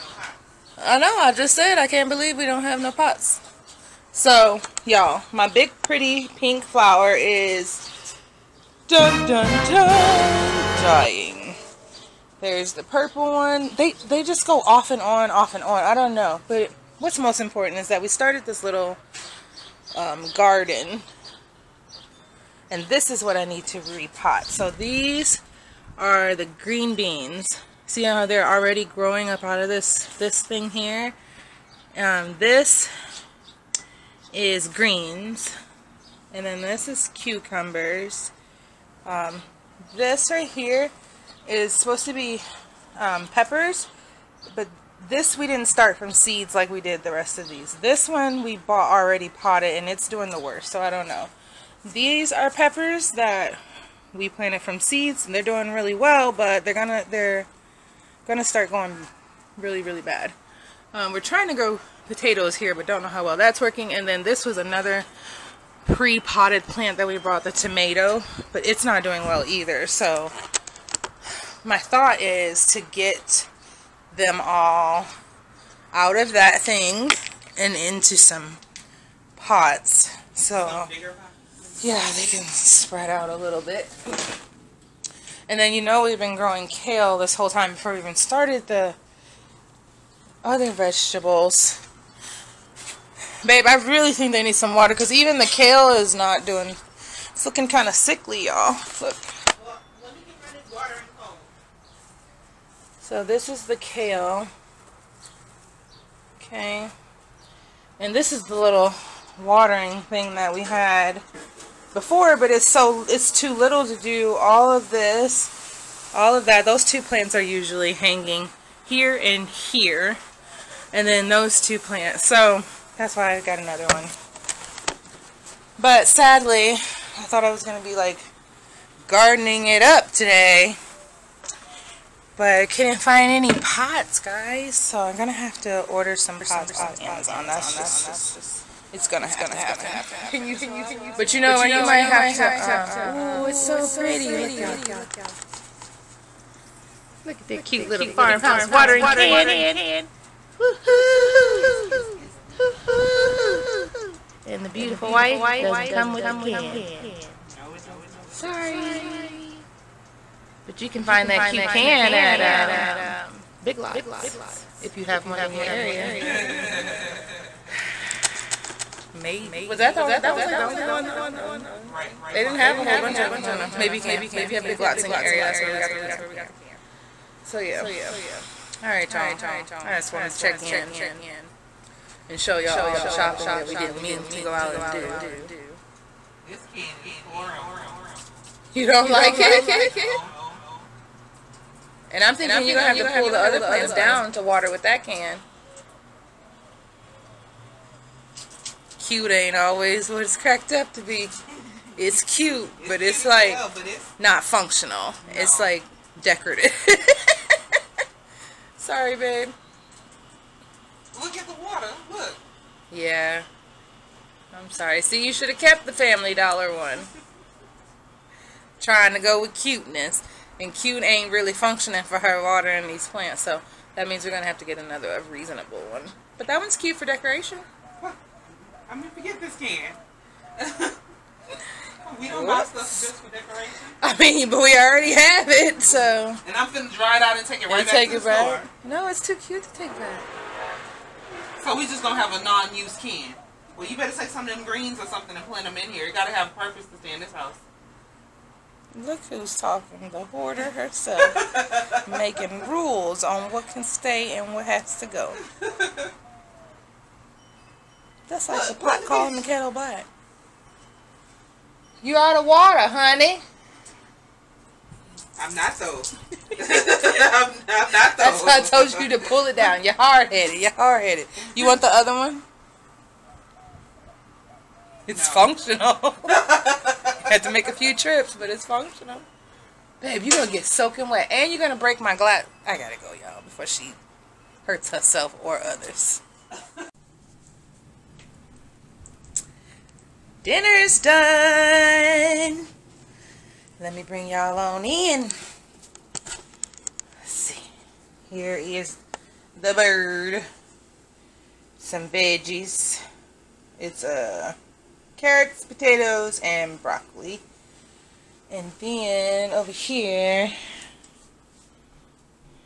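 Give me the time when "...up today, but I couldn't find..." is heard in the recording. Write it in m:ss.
2:09.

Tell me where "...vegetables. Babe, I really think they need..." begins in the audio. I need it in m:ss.
1:30.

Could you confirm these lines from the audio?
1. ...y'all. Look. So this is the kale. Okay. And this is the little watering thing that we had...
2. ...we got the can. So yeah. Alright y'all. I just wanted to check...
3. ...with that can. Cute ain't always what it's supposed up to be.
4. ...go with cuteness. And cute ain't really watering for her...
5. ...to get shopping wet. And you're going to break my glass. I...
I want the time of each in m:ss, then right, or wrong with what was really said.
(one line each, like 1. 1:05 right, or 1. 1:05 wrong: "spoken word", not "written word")
1. 1:38 right
2. 2:55 right
3. 3:14 wrong: "cracked", not "supposed"
4. 3:39 wrong: "functioning", not "watering"
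5. 4:40 wrong: "soaking", not "shopping".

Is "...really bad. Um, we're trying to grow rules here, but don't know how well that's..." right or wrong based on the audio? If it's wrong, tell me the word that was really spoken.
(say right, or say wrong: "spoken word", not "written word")
wrong: "potatoes", not "rules".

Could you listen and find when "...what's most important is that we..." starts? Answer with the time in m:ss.
0:16.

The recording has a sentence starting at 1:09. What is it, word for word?
So my thought is to get them all out of that thing and into some pots.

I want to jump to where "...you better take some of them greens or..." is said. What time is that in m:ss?
4:03.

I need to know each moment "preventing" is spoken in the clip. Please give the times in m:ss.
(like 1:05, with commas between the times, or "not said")
not said.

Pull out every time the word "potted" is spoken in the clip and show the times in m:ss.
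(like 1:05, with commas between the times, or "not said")
0:49, 1:05.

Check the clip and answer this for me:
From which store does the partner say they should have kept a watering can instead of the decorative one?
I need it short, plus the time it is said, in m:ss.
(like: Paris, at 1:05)
Family Dollar, at 3:35.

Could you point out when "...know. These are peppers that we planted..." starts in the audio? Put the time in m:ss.
0:51.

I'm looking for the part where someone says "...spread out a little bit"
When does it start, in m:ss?
1:22.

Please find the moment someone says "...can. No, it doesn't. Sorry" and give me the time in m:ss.
2:36.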